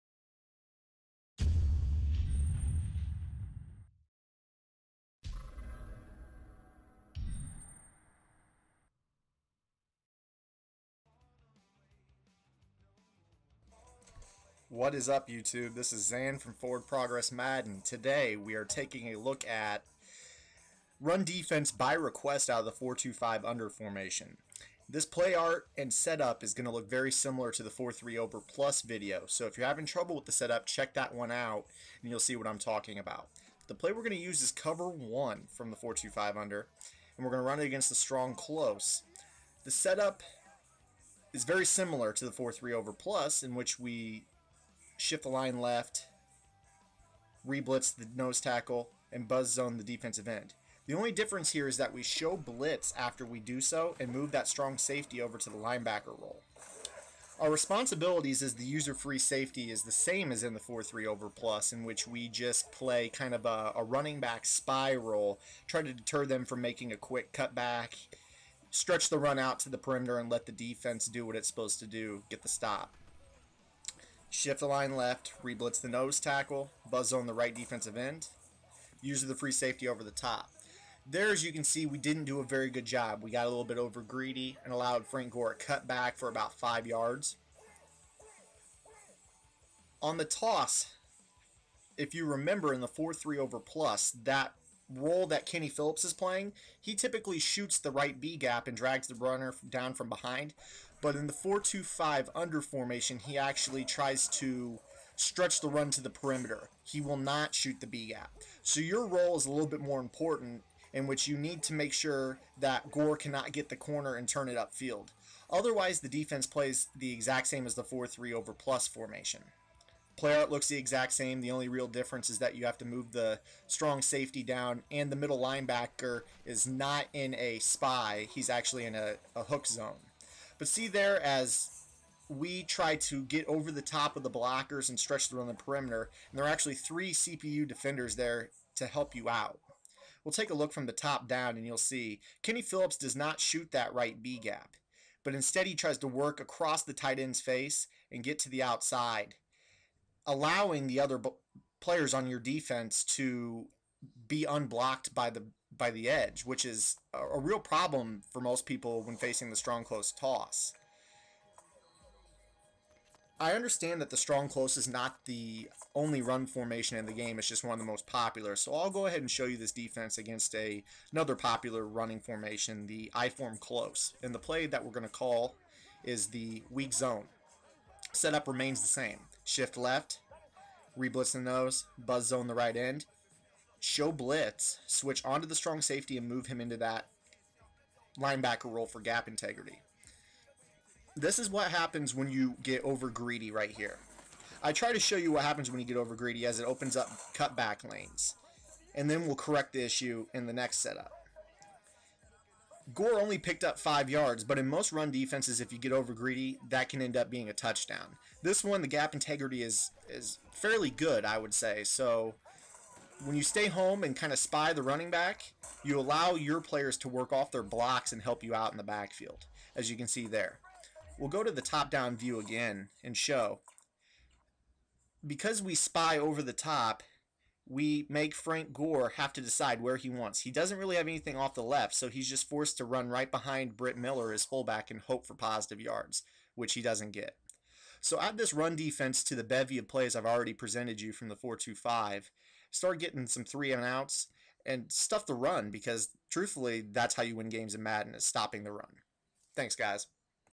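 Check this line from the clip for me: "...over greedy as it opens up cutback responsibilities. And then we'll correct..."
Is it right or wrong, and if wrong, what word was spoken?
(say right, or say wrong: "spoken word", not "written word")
wrong: "lanes", not "responsibilities".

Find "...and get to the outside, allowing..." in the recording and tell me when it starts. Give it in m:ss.
2:28.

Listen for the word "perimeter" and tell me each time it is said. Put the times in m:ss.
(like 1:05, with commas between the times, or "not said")
1:09, 1:46, 2:15.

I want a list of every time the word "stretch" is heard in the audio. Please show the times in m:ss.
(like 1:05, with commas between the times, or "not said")
1:08, 1:45, 2:14.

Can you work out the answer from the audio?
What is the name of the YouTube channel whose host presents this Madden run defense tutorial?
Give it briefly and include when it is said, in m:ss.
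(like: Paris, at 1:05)
Forward Progress Madden, at 0:16.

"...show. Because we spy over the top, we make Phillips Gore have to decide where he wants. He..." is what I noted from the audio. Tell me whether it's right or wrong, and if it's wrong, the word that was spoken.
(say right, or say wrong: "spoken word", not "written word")
wrong: "Frank", not "Phillips".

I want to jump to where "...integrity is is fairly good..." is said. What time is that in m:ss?
3:29.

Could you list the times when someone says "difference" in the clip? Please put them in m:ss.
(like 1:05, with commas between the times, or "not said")
0:51, 2:01.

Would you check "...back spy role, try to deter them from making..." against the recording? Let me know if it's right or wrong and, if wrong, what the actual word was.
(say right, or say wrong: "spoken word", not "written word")
right.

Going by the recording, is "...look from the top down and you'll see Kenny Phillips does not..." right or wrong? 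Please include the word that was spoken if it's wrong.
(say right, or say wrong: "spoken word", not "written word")
right.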